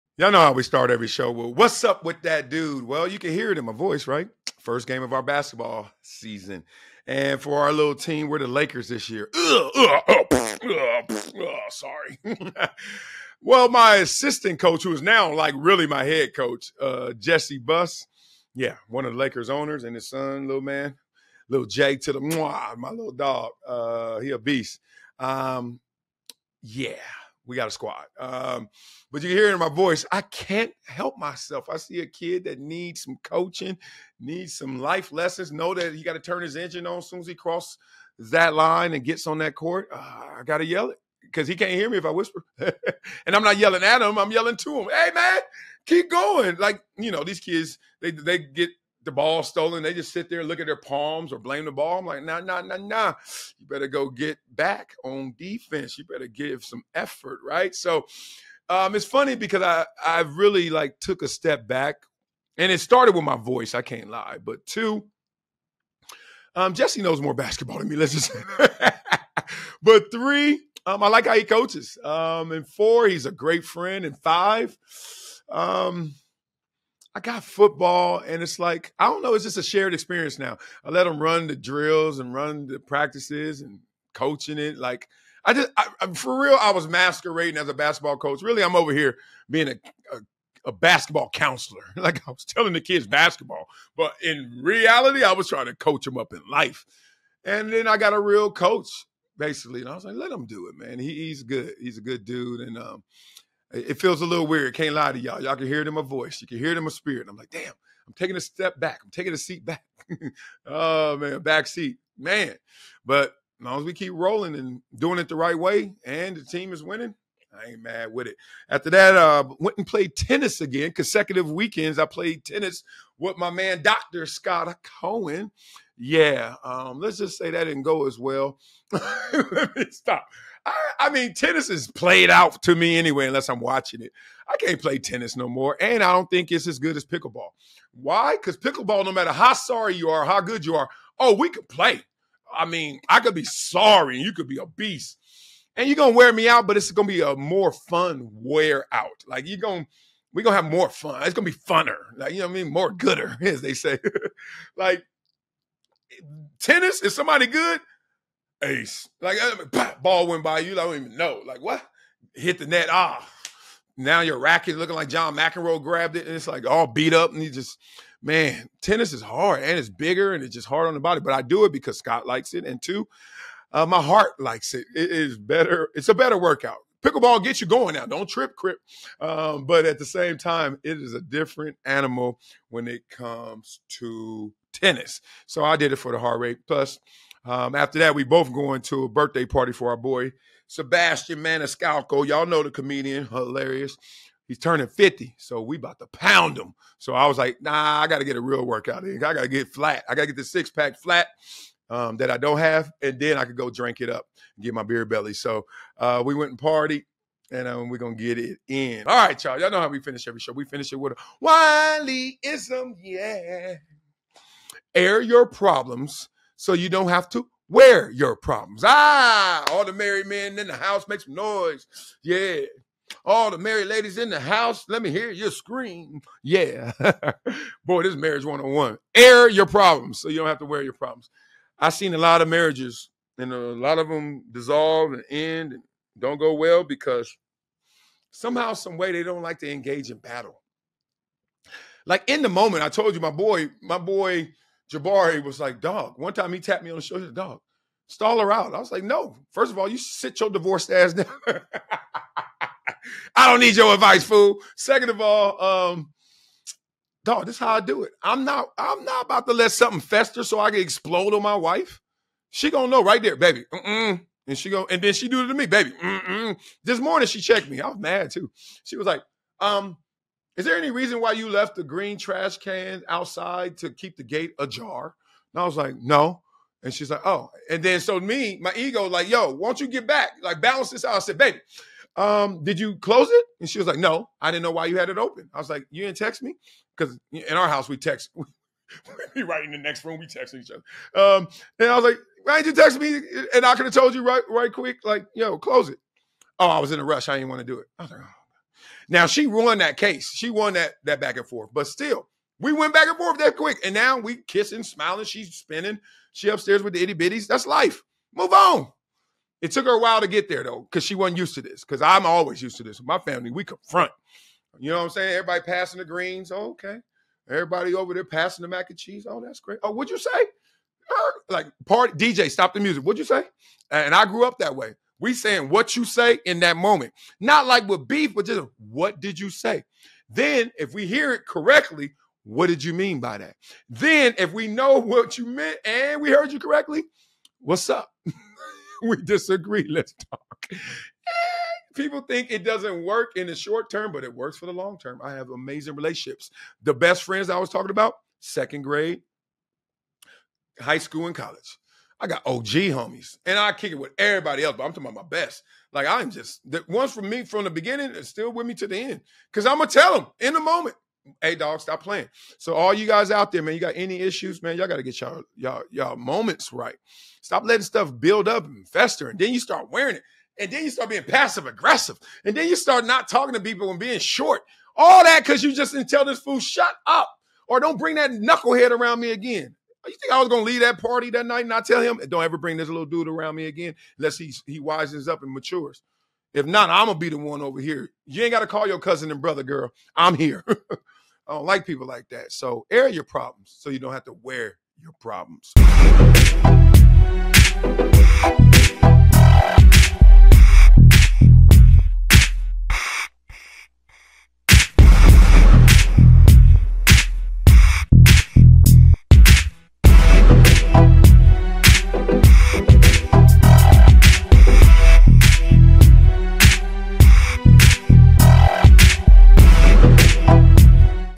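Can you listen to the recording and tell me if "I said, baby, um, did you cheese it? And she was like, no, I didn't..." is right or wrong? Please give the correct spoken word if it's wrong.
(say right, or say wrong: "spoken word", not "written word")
wrong: "close", not "cheese".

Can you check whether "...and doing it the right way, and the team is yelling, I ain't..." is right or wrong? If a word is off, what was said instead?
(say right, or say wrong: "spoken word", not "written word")
wrong: "winning", not "yelling".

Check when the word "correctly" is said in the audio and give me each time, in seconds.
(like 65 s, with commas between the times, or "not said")
331 s, 336 s.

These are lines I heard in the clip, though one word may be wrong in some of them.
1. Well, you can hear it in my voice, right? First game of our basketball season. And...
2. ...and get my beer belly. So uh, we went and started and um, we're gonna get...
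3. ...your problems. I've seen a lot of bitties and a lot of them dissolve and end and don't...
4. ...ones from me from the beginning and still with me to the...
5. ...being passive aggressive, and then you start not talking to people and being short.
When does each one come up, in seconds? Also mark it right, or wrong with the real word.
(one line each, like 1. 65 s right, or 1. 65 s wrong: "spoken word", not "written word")
1. 2 s right
2. 204 s wrong: "partied", not "started"
3. 230 s wrong: "marriages", not "bitties"
4. 356 s right
5. 371 s right.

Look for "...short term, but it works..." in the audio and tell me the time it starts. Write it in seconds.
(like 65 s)
343 s.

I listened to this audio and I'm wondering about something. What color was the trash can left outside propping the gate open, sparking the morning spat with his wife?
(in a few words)
Green.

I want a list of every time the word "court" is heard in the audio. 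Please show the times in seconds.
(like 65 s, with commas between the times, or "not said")
39 s.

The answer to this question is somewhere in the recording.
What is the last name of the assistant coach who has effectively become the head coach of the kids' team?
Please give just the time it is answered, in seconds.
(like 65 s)
17 s.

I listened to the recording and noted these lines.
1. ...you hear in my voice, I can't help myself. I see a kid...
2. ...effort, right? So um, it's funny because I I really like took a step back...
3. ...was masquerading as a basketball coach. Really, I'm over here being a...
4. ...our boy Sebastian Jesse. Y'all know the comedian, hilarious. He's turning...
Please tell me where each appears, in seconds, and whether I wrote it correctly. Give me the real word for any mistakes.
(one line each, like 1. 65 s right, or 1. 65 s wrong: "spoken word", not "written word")
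1. 29 s right
2. 56 s right
3. 86 s right
4. 189 s wrong: "Maniscalco", not "Jesse".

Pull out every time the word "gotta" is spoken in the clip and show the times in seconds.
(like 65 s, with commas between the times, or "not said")
364 s, 388 s.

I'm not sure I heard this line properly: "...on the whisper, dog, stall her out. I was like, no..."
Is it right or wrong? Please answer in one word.
wrong.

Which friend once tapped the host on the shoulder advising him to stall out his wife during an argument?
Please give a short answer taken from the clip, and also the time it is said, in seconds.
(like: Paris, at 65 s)
Jabari, at 243 s.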